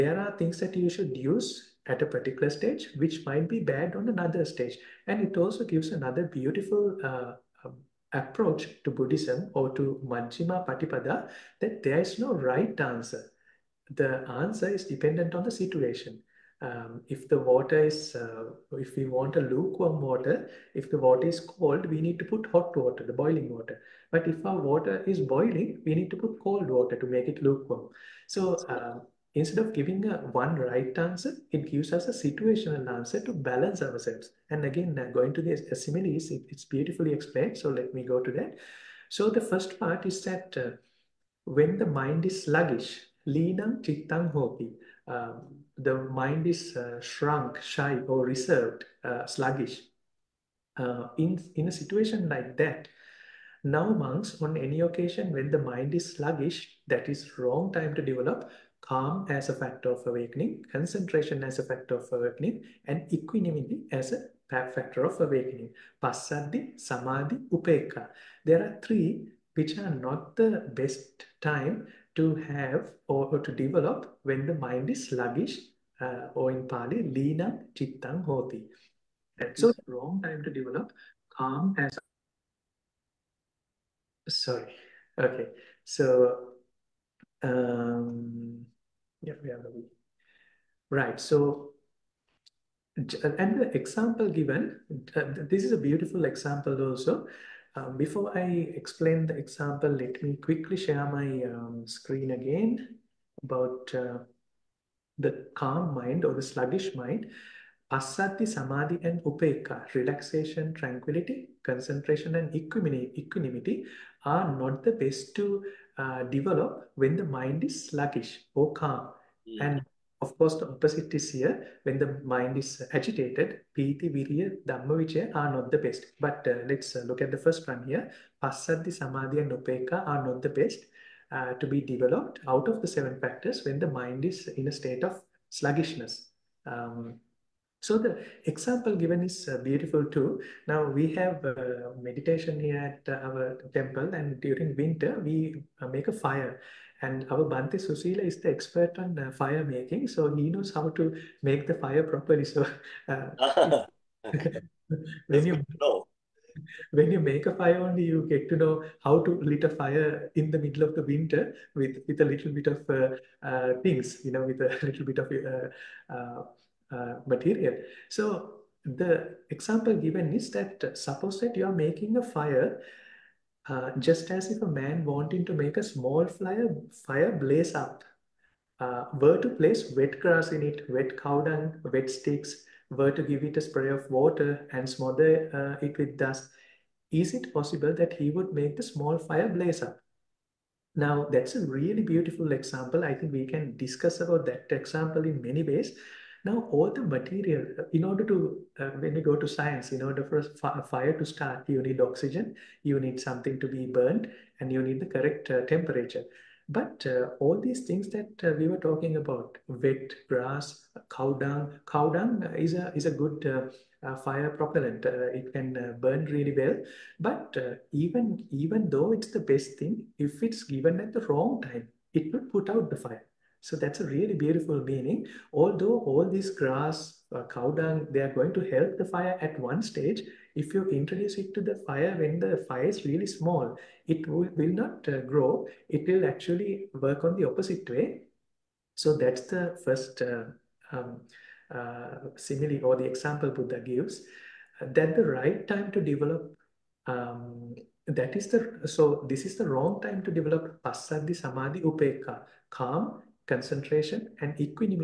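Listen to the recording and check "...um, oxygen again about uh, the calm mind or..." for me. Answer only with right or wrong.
wrong.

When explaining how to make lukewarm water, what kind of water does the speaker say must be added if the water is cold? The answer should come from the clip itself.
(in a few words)
boiling water.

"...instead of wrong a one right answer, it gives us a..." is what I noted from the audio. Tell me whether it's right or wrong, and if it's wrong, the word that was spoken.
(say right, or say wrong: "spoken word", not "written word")
wrong: "giving", not "wrong".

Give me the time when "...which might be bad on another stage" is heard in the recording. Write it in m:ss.
0:02.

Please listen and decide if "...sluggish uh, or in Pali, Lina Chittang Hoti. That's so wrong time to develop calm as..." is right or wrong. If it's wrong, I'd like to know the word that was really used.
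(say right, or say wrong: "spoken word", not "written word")
right.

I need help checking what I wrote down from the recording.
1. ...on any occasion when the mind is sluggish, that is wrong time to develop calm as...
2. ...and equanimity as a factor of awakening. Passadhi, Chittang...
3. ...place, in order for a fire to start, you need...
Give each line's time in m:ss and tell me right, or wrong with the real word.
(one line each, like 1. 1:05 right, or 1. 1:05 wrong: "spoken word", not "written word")
1. 0:54 right
2. 1:02 wrong: "Samadhi", not "Chittang"
3. 3:19 wrong: "science", not "place".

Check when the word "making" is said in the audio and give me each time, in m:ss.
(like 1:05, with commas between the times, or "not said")
2:29, 2:51.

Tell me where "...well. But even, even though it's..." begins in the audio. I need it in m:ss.
3:36.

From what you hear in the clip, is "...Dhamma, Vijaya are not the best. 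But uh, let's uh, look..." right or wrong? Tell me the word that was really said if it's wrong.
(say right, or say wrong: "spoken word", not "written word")
right.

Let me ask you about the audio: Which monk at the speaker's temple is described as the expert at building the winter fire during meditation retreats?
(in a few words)
Bhante Susila.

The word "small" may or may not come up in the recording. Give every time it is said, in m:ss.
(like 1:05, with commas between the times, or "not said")
2:55, 3:08, 3:53.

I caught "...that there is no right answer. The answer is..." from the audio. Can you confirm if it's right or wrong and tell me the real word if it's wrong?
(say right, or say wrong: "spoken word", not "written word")
right.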